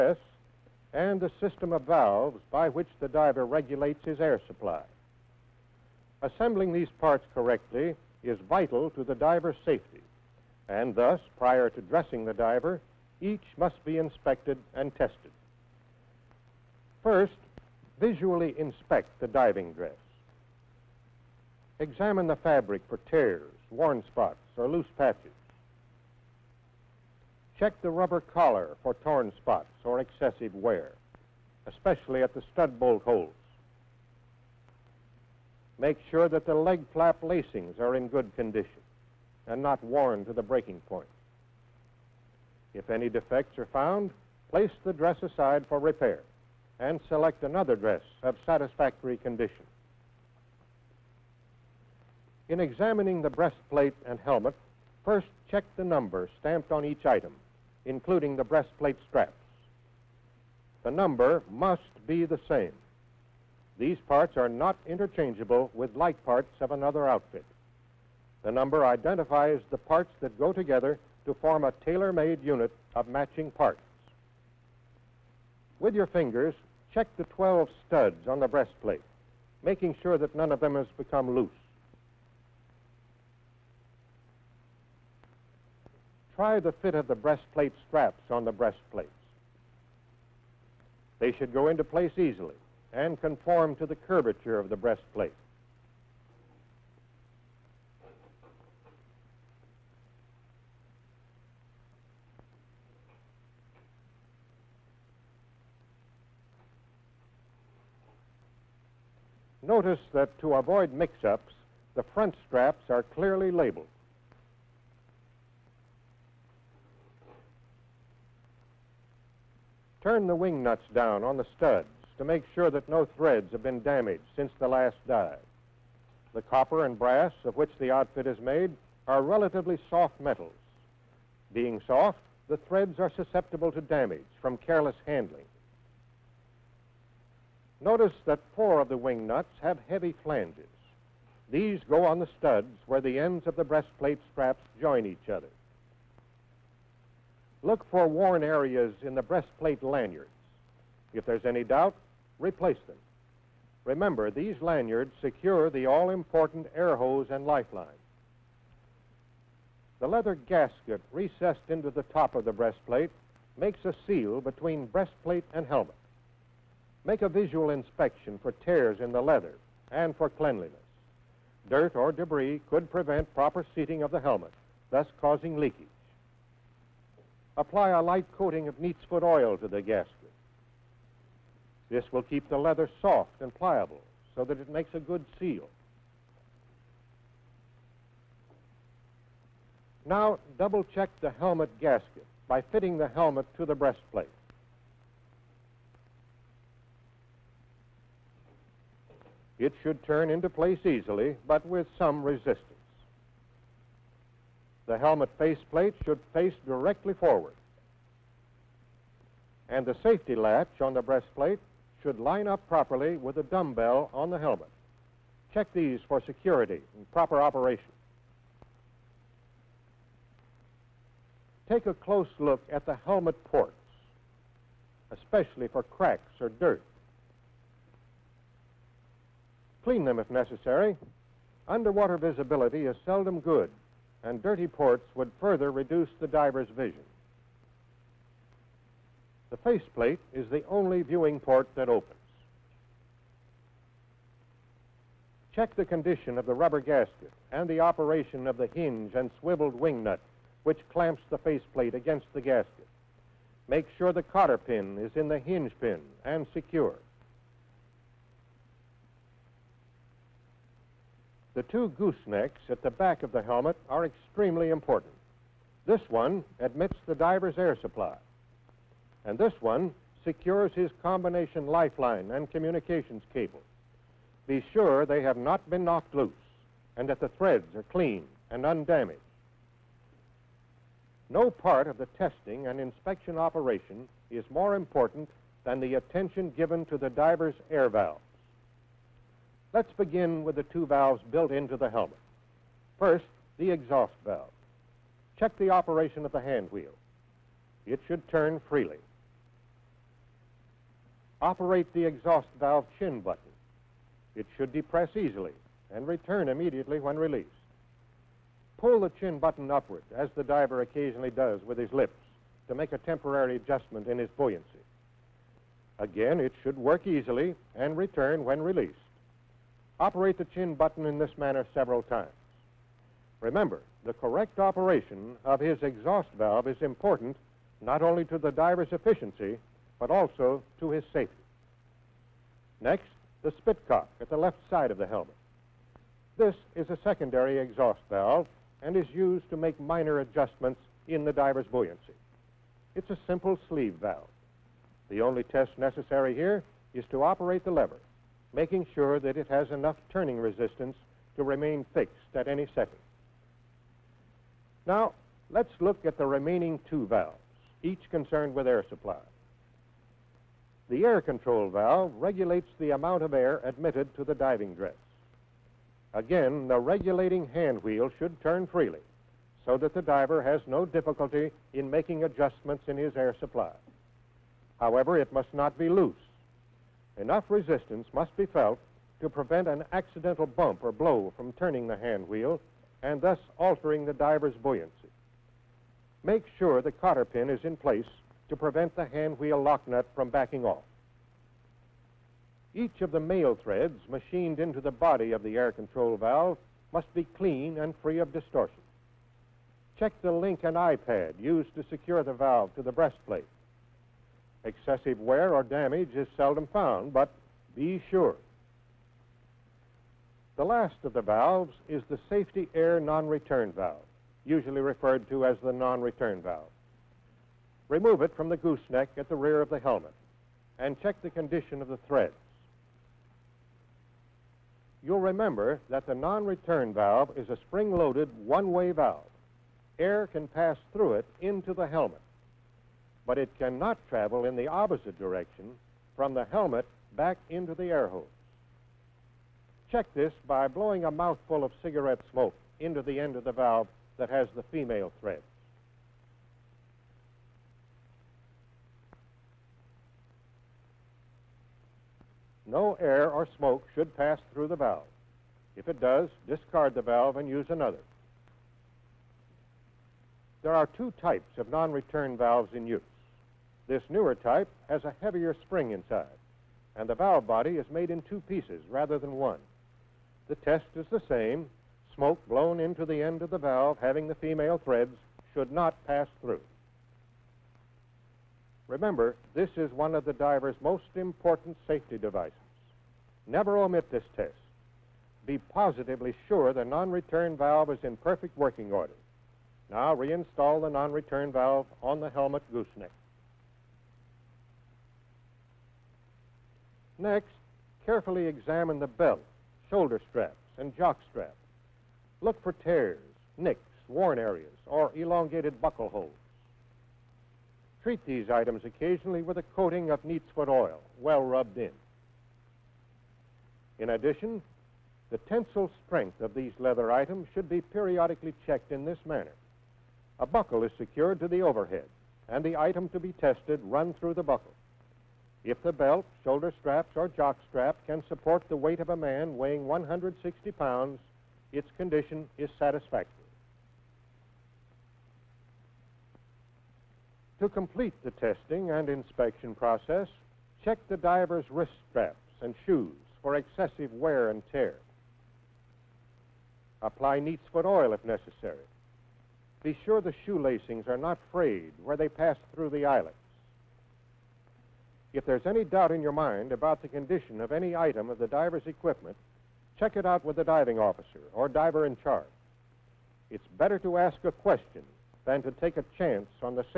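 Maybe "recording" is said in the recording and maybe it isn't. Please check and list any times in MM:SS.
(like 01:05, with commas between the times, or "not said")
not said.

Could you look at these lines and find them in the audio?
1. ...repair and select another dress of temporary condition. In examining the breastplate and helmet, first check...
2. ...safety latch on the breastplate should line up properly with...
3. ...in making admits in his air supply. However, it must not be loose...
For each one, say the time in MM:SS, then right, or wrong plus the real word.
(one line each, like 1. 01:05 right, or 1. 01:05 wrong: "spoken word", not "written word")
1. 00:45 wrong: "satisfactory", not "temporary"
2. 03:30 right
3. 06:11 wrong: "adjustments", not "admits".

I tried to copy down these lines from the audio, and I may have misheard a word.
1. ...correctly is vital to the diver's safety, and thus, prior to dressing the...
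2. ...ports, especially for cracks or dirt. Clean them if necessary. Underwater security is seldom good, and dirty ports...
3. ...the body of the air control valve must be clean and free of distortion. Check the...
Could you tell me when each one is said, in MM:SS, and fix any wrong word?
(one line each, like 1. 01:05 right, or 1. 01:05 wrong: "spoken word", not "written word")
1. 00:07 right
2. 03:43 wrong: "visibility", not "security"
3. 06:34 right.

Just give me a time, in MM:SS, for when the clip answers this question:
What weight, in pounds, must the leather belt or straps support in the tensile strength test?
08:49.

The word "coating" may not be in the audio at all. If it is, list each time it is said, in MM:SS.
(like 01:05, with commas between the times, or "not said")
02:58, 08:29.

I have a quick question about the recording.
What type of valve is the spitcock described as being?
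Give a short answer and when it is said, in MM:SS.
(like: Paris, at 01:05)
Sleeve valve, at 05:43.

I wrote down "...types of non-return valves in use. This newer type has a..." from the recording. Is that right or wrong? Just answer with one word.
right.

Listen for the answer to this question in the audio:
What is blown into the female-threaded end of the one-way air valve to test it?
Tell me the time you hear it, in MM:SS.
07:21.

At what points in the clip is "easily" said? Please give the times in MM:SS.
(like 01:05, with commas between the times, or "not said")
01:32, 03:20, 05:05, 05:17.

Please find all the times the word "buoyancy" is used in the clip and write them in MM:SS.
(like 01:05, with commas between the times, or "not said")
05:14, 05:41, 06:24.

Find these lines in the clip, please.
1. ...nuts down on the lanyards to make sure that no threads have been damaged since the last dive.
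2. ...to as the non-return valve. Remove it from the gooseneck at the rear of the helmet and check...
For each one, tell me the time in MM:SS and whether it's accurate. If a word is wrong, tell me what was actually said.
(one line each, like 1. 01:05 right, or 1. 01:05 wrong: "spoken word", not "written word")
1. 02:00 wrong: "studs", not "lanyards"
2. 06:55 right.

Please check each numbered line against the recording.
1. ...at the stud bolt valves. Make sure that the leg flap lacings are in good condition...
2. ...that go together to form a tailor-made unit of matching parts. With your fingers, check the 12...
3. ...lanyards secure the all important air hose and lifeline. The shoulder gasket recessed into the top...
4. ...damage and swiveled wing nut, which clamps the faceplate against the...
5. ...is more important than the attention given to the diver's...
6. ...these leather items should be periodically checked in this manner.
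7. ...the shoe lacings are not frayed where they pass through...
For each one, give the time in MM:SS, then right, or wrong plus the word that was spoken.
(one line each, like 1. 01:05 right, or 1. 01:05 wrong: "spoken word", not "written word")
1. 00:32 wrong: "holes", not "valves"
2. 01:10 right
3. 02:34 wrong: "leather", not "shoulder"
4. 04:08 wrong: "hinge", not "damage"
5. 04:44 right
6. 08:36 right
7. 09:10 right.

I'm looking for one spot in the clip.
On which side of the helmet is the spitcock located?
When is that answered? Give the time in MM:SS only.
05:34.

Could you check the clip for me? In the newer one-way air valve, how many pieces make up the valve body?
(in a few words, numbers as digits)
2.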